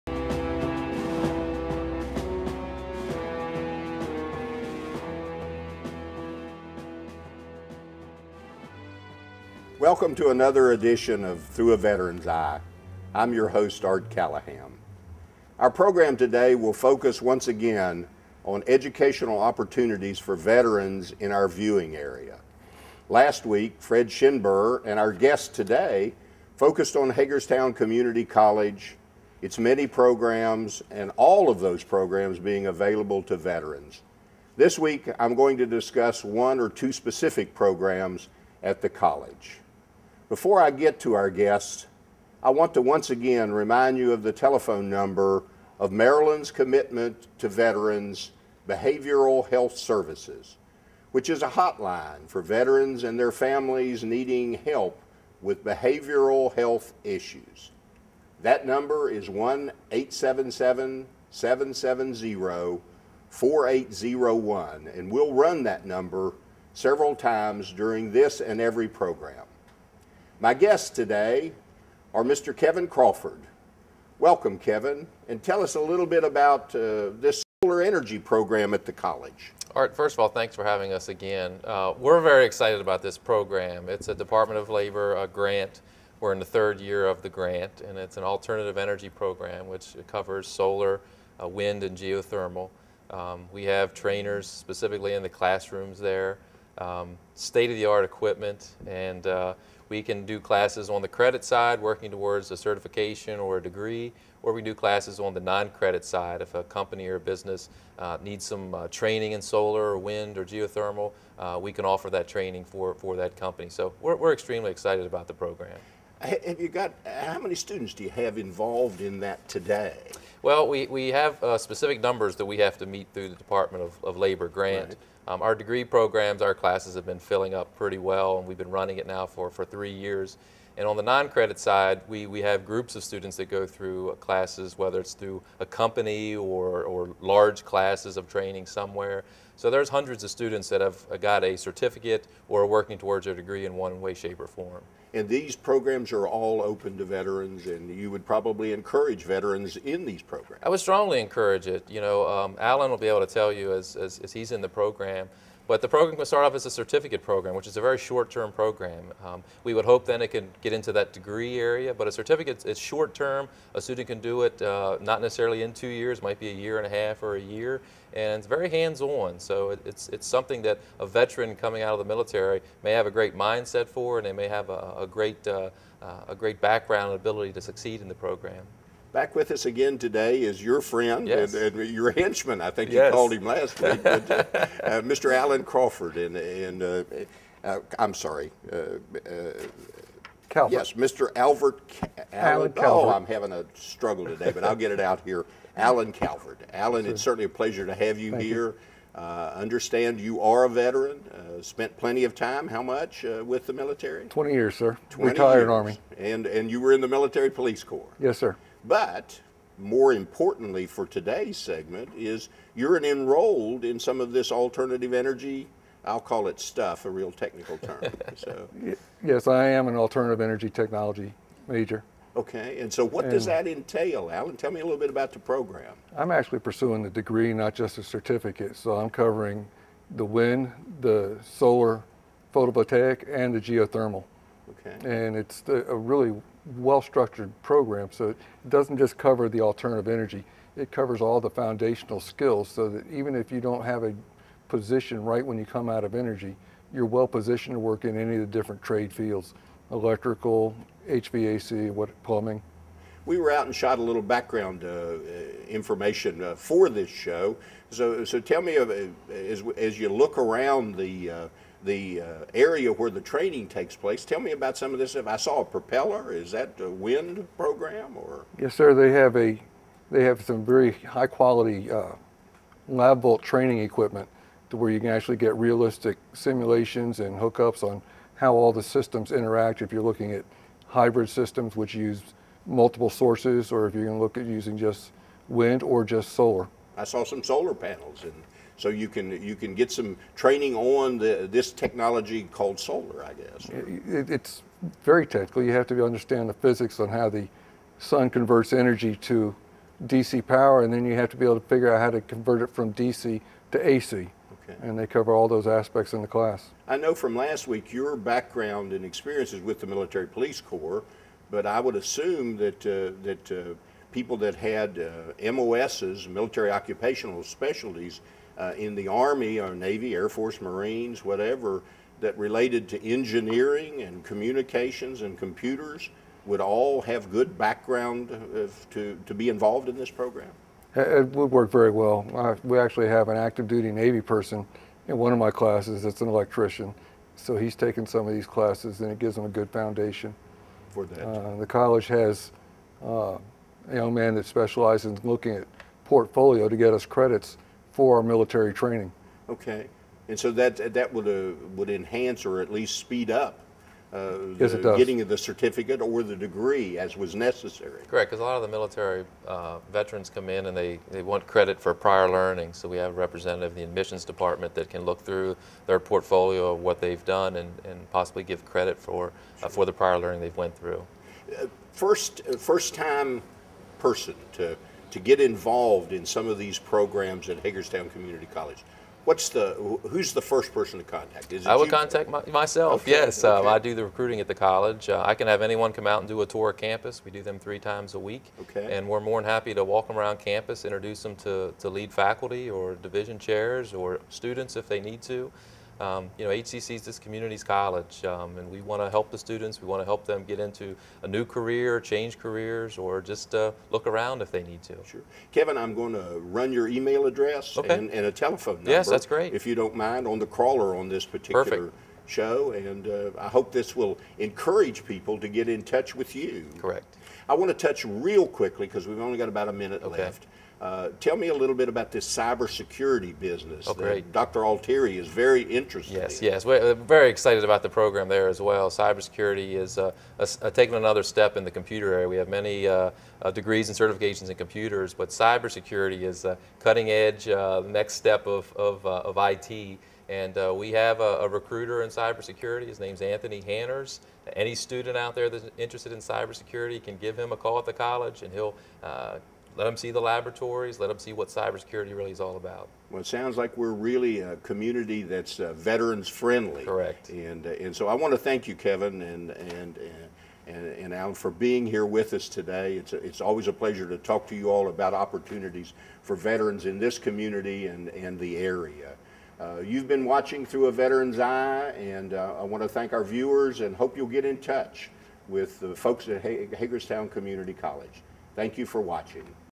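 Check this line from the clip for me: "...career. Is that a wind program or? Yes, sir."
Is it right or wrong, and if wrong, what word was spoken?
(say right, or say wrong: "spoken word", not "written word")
wrong: "propeller", not "career".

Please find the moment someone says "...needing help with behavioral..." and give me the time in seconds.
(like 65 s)
54 s.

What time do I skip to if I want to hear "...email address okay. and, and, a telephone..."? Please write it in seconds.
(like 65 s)
406 s.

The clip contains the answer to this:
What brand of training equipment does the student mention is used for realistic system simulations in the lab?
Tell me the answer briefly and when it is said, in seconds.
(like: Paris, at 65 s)
Lab-Volt, at 272 s.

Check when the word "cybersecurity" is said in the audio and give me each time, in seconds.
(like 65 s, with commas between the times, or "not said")
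422 s, 428 s, 435 s, 442 s, 446 s, 451 s.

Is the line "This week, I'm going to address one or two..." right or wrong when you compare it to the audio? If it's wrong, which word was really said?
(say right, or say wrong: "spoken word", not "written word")
wrong: "discuss", not "address".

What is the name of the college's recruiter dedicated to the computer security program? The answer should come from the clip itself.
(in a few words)
Anthony Hanners.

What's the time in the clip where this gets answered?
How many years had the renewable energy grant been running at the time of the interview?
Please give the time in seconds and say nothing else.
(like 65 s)
86 s.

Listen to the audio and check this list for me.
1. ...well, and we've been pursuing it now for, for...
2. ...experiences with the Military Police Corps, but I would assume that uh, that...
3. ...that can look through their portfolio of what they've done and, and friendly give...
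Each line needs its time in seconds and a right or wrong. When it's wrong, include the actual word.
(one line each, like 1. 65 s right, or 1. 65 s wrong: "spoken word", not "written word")
1. 127 s wrong: "running", not "pursuing"
2. 309 s right
3. 364 s wrong: "possibly", not "friendly".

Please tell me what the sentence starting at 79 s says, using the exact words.
All right, first of all, thanks for having us again.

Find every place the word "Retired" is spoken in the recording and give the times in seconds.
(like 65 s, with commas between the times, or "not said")
205 s.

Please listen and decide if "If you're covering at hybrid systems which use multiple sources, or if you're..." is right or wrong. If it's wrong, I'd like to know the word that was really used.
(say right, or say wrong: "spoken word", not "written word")
wrong: "looking", not "covering".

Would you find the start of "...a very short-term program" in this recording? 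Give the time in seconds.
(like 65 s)
157 s.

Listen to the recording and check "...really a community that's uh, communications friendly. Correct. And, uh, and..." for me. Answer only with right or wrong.
wrong.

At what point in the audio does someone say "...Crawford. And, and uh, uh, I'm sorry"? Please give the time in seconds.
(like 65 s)
185 s.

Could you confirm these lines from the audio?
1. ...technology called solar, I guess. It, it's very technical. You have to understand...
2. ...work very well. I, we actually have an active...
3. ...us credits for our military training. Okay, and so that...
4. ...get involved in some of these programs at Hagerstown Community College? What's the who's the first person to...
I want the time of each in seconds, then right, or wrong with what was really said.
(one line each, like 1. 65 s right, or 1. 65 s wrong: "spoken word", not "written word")
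1. 291 s right
2. 331 s right
3. 346 s right
4. 375 s right.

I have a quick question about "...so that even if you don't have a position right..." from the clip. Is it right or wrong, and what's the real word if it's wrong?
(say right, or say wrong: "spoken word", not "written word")
right.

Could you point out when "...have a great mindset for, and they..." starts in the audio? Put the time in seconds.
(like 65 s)
172 s.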